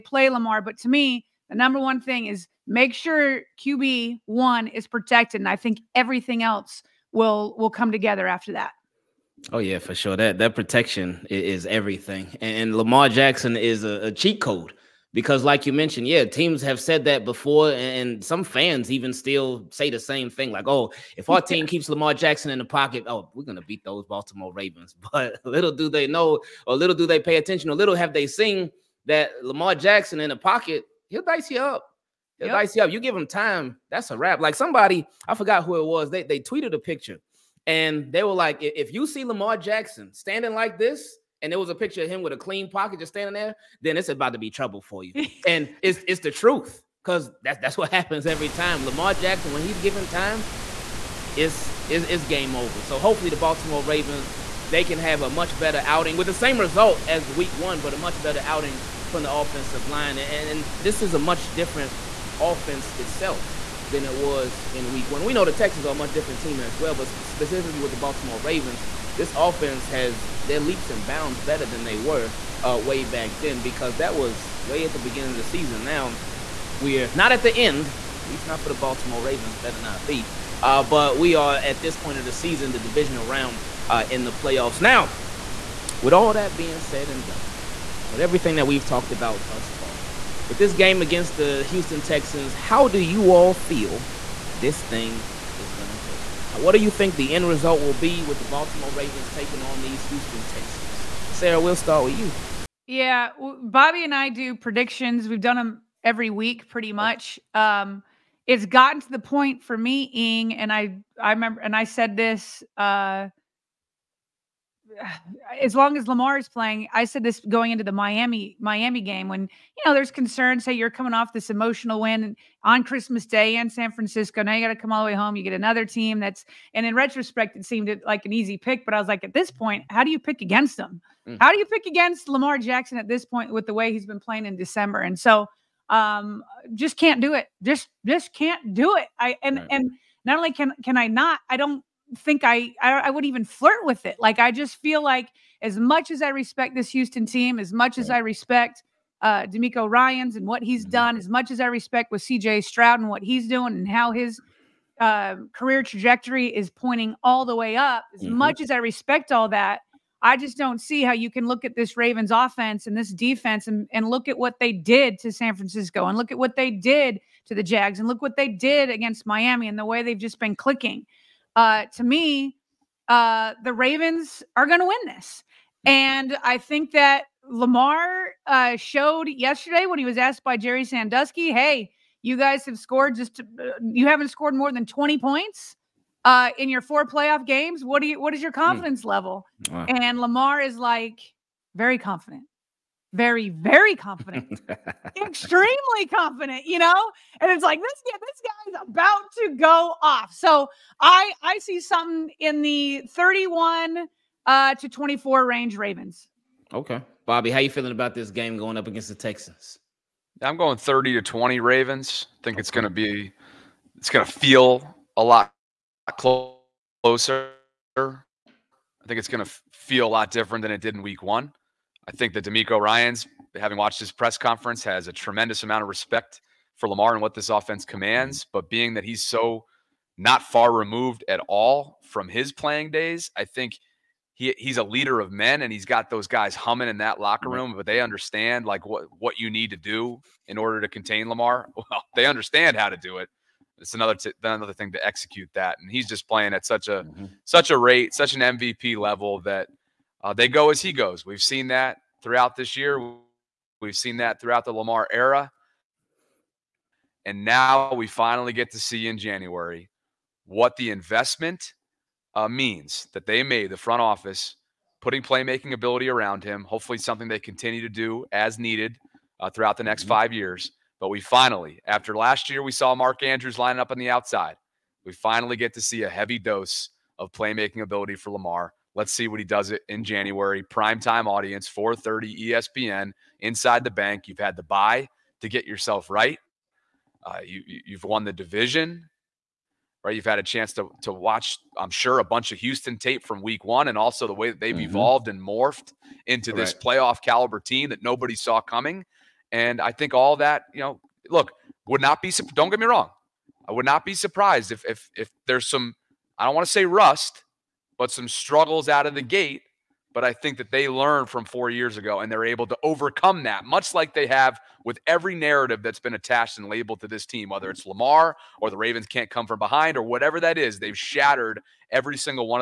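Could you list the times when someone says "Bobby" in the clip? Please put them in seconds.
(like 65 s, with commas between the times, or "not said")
103 s, 207 s.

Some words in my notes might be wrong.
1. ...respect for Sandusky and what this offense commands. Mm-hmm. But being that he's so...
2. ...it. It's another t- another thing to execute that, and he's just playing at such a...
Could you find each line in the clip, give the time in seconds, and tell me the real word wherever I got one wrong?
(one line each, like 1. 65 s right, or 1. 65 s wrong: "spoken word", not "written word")
1. 225 s wrong: "Lamar", not "Sandusky"
2. 243 s right.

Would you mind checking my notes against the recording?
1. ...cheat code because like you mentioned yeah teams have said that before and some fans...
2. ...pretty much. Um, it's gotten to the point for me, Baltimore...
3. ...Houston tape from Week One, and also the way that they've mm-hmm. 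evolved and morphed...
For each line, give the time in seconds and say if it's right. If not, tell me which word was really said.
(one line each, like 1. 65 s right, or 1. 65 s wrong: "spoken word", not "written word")
1. 14 s right
2. 106 s wrong: "Ing", not "Baltimore"
3. 292 s right.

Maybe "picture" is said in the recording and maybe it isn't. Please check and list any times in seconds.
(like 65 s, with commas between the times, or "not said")
36 s, 41 s.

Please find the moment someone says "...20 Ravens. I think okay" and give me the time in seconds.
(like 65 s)
211 s.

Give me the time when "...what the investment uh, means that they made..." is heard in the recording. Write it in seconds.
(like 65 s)
260 s.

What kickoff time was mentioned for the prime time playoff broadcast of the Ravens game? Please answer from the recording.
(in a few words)
4:30.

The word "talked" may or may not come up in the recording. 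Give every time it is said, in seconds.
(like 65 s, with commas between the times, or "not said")
88 s.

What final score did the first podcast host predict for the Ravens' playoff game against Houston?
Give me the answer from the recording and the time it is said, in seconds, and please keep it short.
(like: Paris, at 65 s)
31 to 24, at 203 s.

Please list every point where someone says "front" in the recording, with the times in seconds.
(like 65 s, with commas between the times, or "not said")
263 s.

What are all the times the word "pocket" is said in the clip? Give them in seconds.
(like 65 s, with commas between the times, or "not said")
22 s, 30 s, 42 s.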